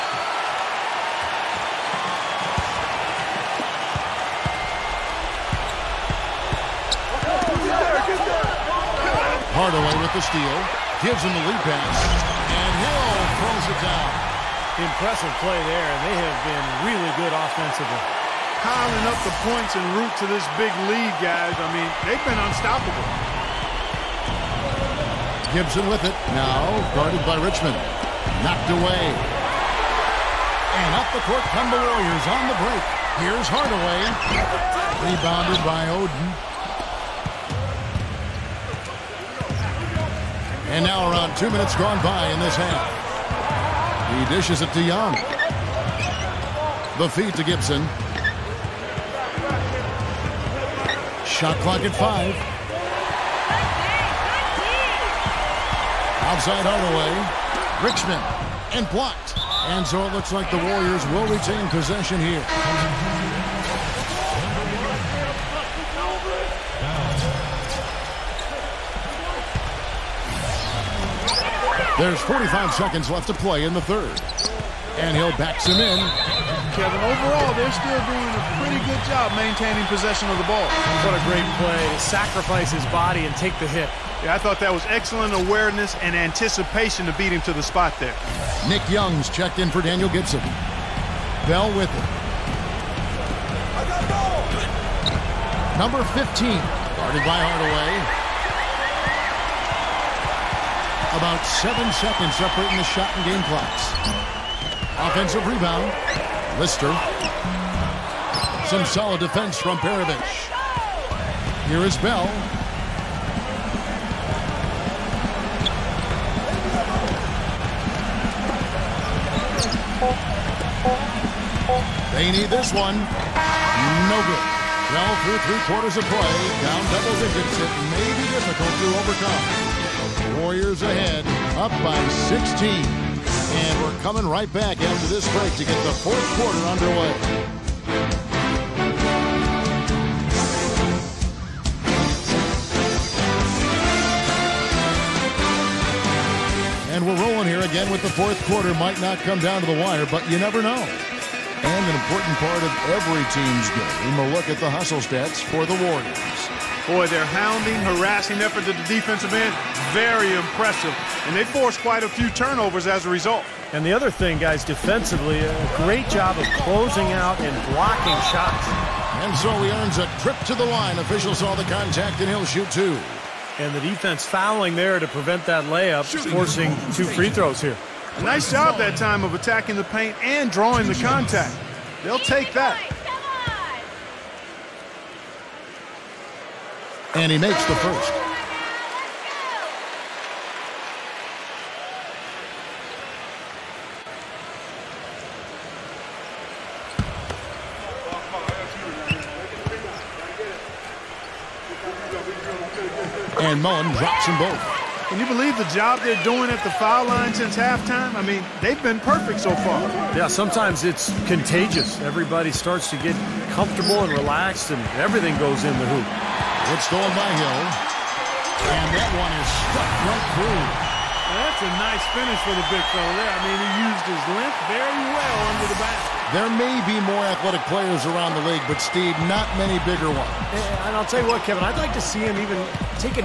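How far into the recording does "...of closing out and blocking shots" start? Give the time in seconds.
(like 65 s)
166 s.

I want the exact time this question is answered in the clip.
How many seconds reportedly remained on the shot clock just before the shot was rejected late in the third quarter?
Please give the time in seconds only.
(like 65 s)
51 s.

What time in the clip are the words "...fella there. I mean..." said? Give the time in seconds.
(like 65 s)
222 s.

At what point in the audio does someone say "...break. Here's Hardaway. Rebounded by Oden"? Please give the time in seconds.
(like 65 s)
32 s.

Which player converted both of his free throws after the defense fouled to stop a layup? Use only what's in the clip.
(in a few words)
Mullin.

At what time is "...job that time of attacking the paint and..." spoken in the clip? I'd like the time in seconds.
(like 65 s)
178 s.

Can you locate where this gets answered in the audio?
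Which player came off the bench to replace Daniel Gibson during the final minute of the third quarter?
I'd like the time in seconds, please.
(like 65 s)
88 s.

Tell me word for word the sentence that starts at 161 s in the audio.
And they forced quite a few turnovers as a result.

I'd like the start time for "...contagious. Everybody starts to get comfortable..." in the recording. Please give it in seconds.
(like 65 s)
211 s.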